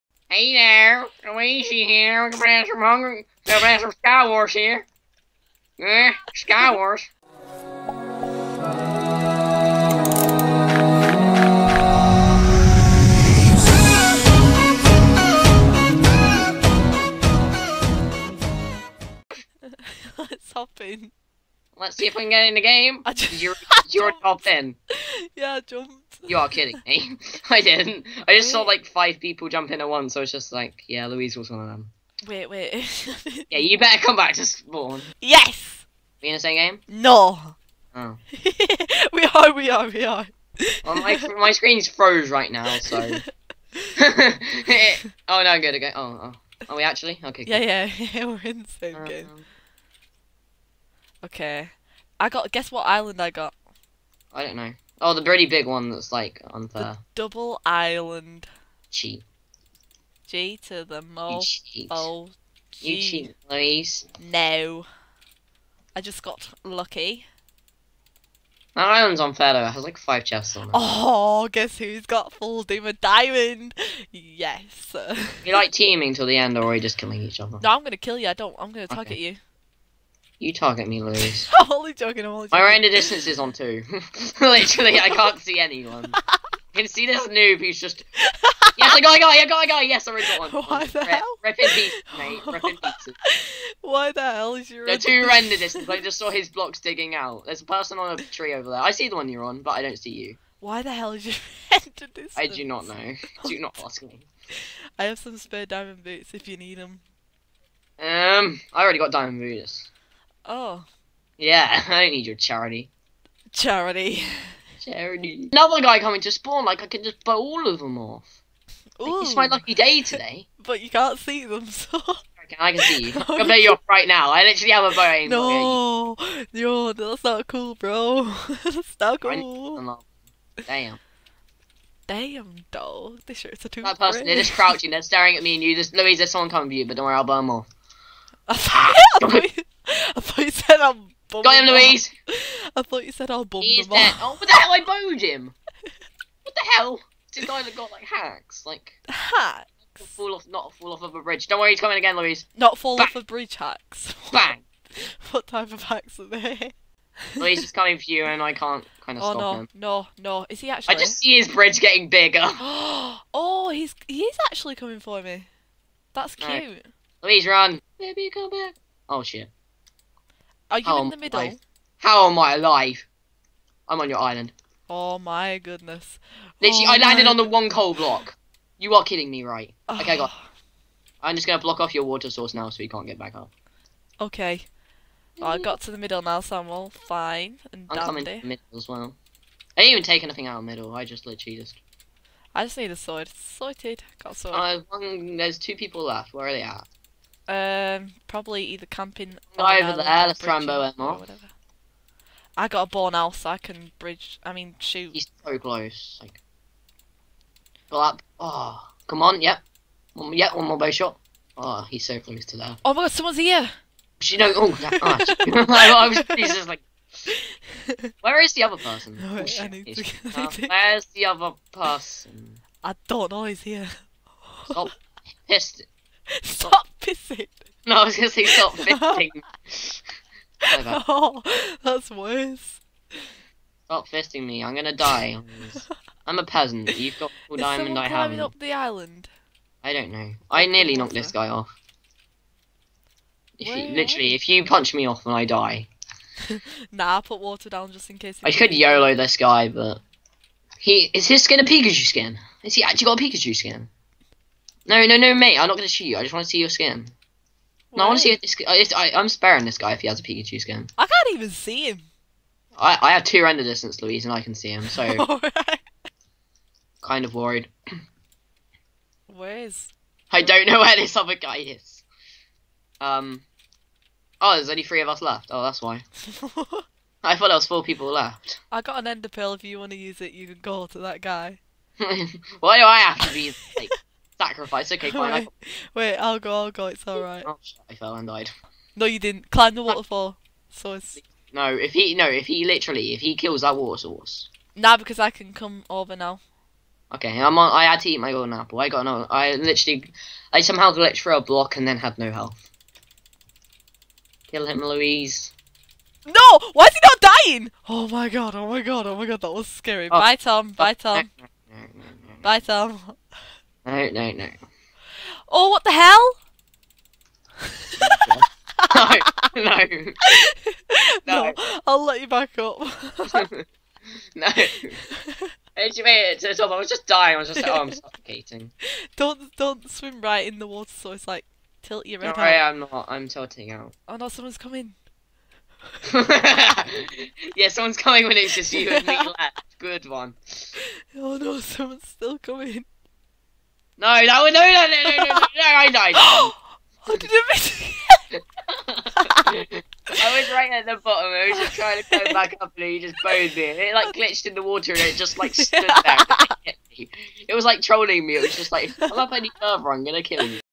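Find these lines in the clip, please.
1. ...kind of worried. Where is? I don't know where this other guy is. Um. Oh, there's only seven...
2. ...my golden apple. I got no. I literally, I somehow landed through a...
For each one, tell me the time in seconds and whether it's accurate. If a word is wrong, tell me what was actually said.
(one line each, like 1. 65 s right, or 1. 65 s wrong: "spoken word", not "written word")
1. 267 s wrong: "three", not "seven"
2. 298 s wrong: "glitched", not "landed".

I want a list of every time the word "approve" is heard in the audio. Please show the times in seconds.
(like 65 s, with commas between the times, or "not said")
not said.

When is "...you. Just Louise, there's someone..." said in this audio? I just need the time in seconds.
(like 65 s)
135 s.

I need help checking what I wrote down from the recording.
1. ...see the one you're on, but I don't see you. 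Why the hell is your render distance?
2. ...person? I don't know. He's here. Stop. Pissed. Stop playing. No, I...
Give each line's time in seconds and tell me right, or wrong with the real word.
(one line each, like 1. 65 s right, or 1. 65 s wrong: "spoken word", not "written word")
1. 98 s right
2. 221 s wrong: "pissing", not "playing".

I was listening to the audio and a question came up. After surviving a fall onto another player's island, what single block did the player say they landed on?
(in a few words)
Coal block.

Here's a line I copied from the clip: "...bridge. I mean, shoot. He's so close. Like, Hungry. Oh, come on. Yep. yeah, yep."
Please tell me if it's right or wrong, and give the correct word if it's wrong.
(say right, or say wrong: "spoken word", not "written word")
wrong: "Black", not "Hungry".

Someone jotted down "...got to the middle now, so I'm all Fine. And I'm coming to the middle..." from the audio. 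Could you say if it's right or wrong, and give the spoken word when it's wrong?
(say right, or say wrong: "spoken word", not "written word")
right.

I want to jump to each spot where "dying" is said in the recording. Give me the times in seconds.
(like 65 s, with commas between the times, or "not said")
307 s, 327 s.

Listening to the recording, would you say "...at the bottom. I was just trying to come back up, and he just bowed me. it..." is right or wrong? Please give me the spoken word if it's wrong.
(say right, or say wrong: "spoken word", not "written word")
right.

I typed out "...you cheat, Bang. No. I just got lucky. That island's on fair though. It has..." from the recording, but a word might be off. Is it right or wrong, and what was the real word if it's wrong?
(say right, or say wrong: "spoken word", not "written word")
wrong: "Louise", not "Bang".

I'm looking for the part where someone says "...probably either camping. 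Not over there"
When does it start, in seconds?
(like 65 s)
198 s.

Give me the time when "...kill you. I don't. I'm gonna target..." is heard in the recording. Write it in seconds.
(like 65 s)
77 s.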